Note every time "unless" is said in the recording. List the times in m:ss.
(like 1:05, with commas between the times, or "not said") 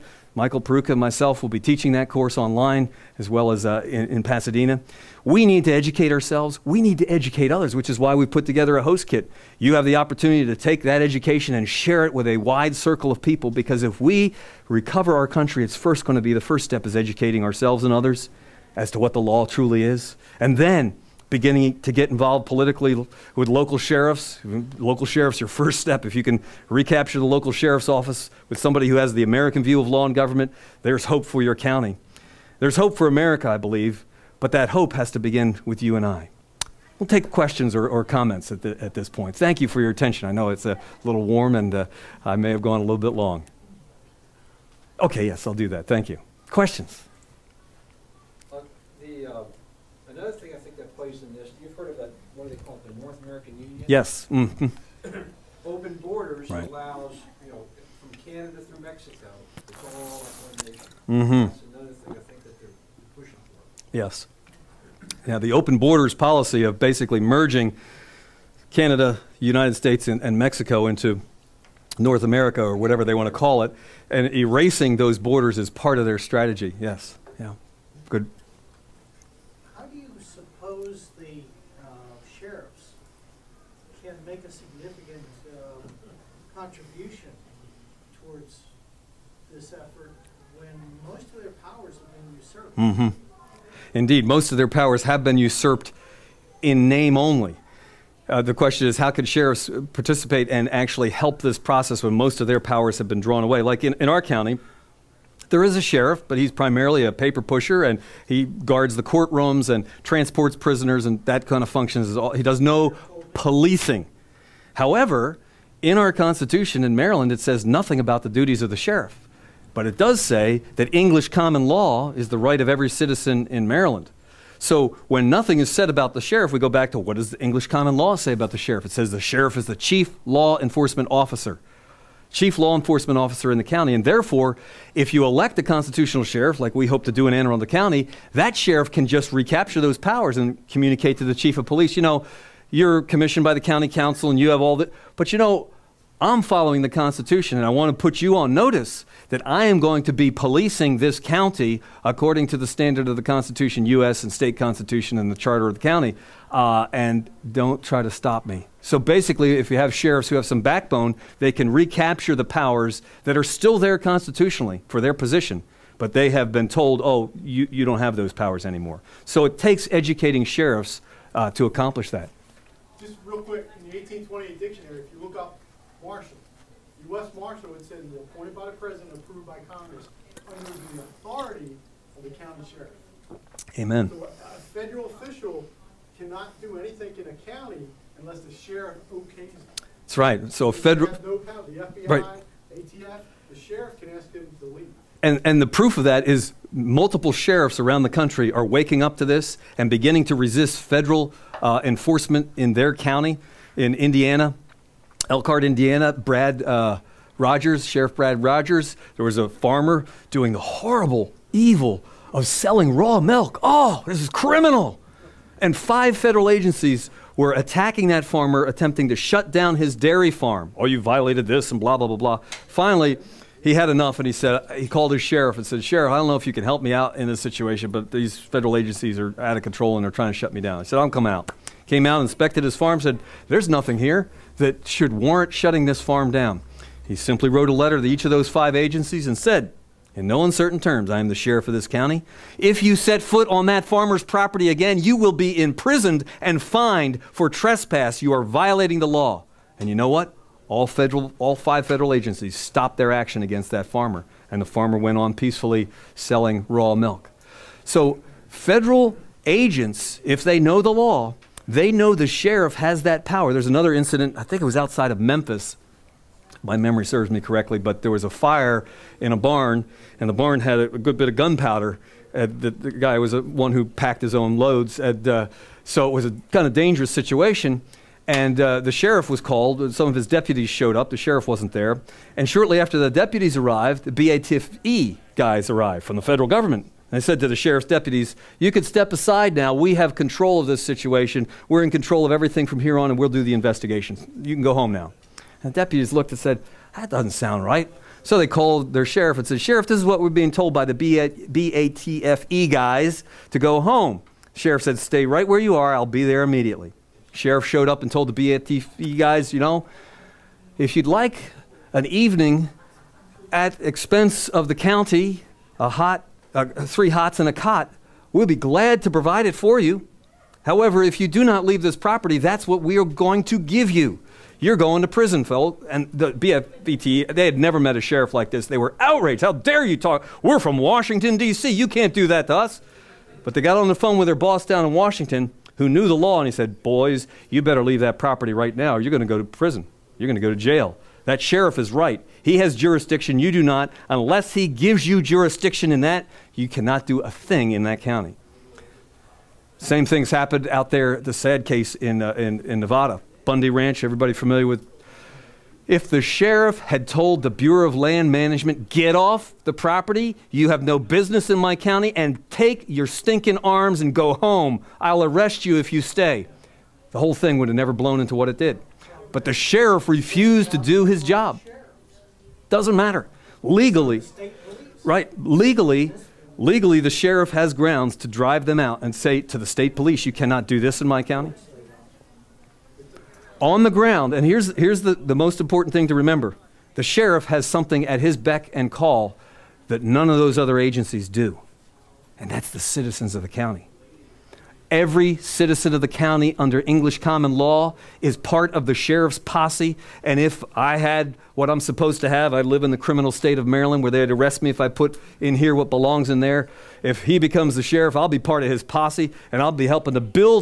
3:08, 5:44.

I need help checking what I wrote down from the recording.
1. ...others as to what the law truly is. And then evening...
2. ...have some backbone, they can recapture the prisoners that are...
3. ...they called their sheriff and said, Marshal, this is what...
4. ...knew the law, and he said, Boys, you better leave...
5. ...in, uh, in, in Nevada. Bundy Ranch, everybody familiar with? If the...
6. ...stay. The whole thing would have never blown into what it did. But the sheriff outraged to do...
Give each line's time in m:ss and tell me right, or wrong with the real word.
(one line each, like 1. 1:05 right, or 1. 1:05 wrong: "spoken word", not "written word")
1. 0:17 wrong: "beginning", not "evening"
2. 2:40 wrong: "powers", not "prisoners"
3. 4:58 wrong: "Sheriff", not "Marshal"
4. 5:35 right
5. 5:51 right
6. 6:05 wrong: "refused", not "outraged".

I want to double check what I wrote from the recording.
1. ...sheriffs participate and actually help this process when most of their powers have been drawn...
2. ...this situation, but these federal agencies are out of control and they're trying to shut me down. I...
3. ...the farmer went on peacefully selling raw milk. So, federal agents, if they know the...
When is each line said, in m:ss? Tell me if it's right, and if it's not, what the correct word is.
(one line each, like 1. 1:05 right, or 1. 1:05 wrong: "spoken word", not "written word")
1. 1:39 right
2. 3:47 right
3. 4:14 right.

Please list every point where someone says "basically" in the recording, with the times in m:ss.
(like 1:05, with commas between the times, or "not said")
1:06, 2:38.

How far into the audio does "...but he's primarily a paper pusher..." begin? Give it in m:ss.
1:46.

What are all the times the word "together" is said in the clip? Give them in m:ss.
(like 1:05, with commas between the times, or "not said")
0:08.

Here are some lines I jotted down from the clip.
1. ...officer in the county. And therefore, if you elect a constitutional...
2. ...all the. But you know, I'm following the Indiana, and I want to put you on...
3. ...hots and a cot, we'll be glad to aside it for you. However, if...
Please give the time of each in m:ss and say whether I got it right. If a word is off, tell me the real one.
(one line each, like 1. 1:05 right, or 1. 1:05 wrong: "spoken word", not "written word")
1. 2:13 right
2. 2:24 wrong: "Constitution", not "Indiana"
3. 5:17 wrong: "provide", not "aside".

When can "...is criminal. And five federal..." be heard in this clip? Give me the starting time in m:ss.
3:34.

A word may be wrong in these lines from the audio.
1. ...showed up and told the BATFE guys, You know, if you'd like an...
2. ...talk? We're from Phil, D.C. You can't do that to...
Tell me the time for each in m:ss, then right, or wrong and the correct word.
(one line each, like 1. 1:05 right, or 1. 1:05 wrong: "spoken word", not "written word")
1. 5:07 right
2. 5:29 wrong: "Washington", not "Phil".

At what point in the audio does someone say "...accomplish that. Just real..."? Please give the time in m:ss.
2:51.